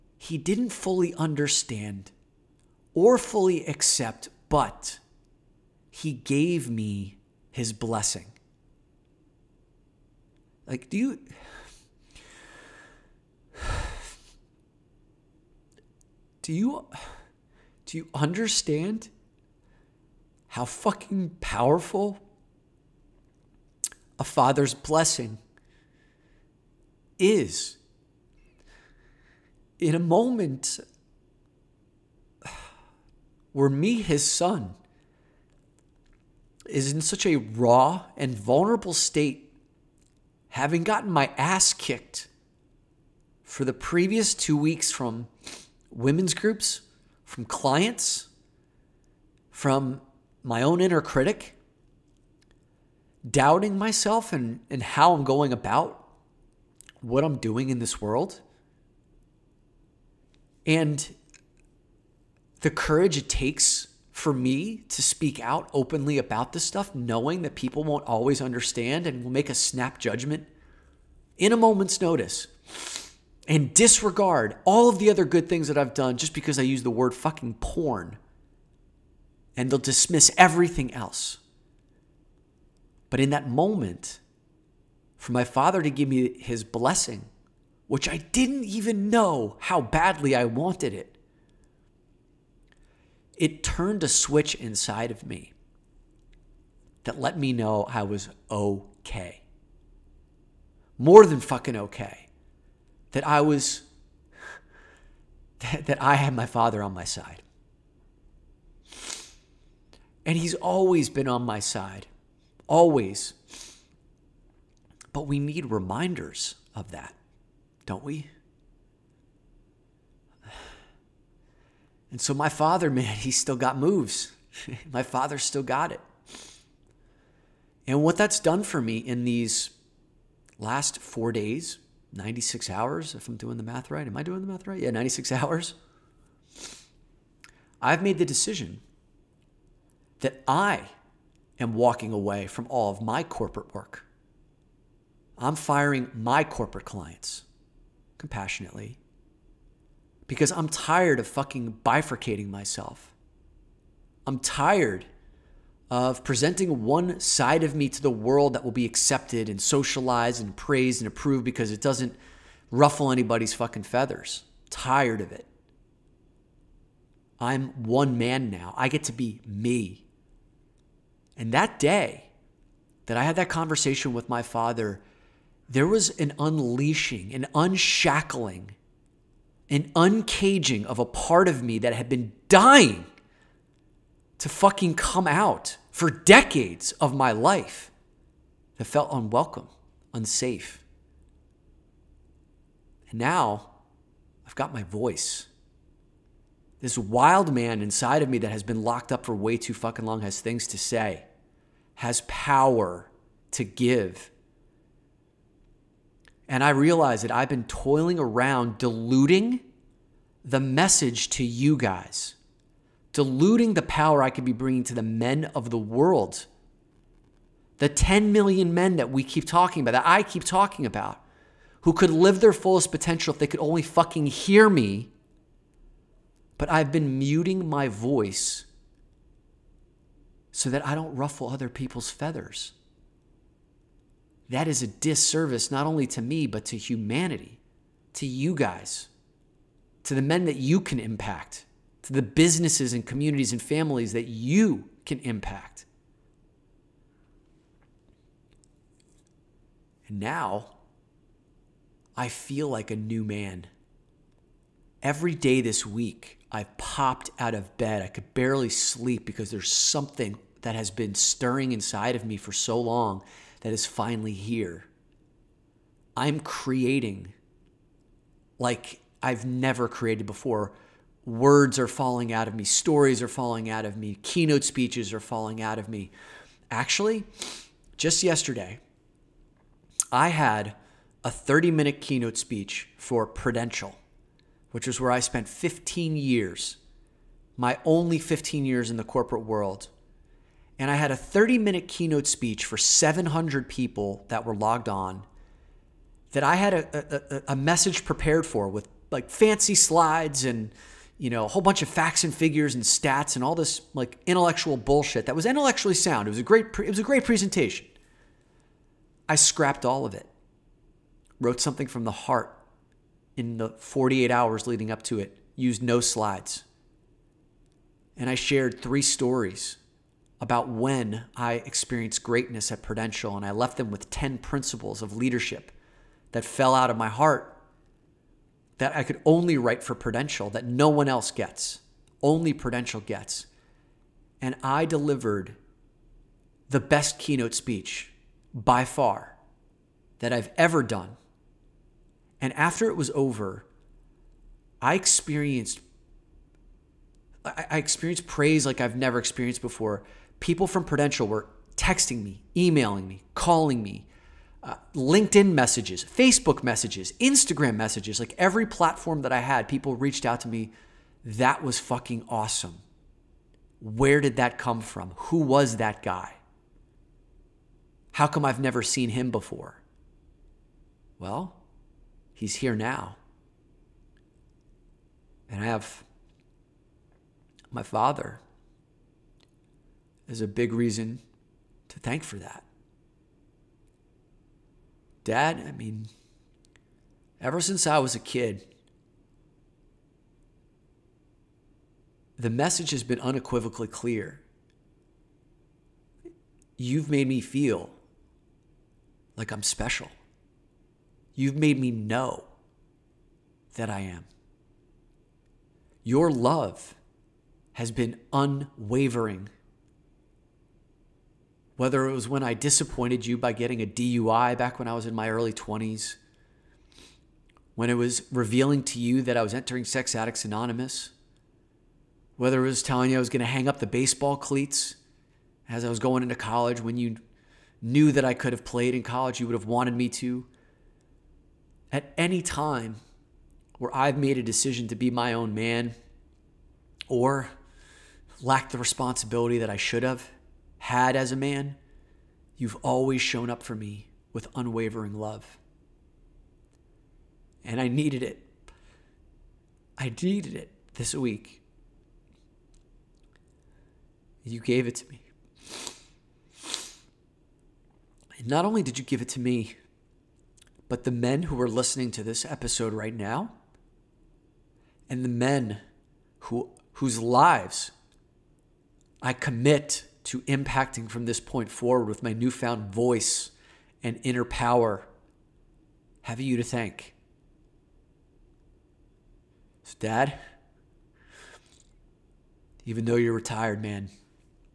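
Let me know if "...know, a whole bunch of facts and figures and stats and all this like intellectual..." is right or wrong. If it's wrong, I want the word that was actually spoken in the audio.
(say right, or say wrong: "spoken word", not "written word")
right.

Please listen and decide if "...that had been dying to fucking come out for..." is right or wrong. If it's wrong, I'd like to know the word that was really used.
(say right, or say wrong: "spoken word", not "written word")
right.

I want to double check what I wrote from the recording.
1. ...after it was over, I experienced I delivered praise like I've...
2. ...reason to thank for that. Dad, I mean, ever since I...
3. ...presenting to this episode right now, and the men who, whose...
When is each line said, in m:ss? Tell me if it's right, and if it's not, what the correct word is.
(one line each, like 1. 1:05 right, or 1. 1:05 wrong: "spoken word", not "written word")
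1. 5:42 wrong: "experienced", not "delivered"
2. 6:20 right
3. 7:41 wrong: "listening", not "presenting".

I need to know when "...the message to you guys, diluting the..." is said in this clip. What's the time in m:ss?
3:30.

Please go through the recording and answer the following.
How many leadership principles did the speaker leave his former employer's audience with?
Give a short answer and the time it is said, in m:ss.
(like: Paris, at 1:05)
10, at 5:24.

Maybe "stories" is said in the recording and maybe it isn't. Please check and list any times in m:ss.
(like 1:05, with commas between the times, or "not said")
4:32, 5:19.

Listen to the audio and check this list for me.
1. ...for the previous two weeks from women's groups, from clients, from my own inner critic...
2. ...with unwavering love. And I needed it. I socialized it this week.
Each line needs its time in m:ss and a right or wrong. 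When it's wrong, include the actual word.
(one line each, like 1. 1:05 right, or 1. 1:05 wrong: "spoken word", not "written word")
1. 0:43 right
2. 7:24 wrong: "needed", not "socialized".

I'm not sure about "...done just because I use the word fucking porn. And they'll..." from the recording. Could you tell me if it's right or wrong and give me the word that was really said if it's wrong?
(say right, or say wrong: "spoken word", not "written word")
right.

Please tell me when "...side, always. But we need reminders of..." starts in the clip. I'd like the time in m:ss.
1:51.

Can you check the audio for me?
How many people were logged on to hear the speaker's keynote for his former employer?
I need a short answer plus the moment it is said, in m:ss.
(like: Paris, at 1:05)
700, at 4:52.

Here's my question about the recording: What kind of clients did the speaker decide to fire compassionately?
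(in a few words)
Corporate clients.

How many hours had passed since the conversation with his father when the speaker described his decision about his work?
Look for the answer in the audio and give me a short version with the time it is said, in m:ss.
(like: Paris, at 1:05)
96, at 2:12.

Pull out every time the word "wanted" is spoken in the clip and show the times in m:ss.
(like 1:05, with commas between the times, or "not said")
1:30, 7:09.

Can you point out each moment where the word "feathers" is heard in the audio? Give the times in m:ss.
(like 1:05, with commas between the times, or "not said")
2:43, 3:52.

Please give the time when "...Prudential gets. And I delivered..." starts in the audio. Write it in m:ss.
5:32.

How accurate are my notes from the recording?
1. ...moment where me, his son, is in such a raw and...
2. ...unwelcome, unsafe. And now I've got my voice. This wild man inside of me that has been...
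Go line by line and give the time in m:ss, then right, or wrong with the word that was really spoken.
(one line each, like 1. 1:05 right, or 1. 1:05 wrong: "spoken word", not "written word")
1. 0:29 right
2. 3:09 right.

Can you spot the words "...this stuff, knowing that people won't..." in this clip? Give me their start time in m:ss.
1:06.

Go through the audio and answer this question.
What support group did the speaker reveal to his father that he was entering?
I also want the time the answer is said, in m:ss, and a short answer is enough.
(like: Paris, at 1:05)
Sex Addicts Anonymous, at 6:59.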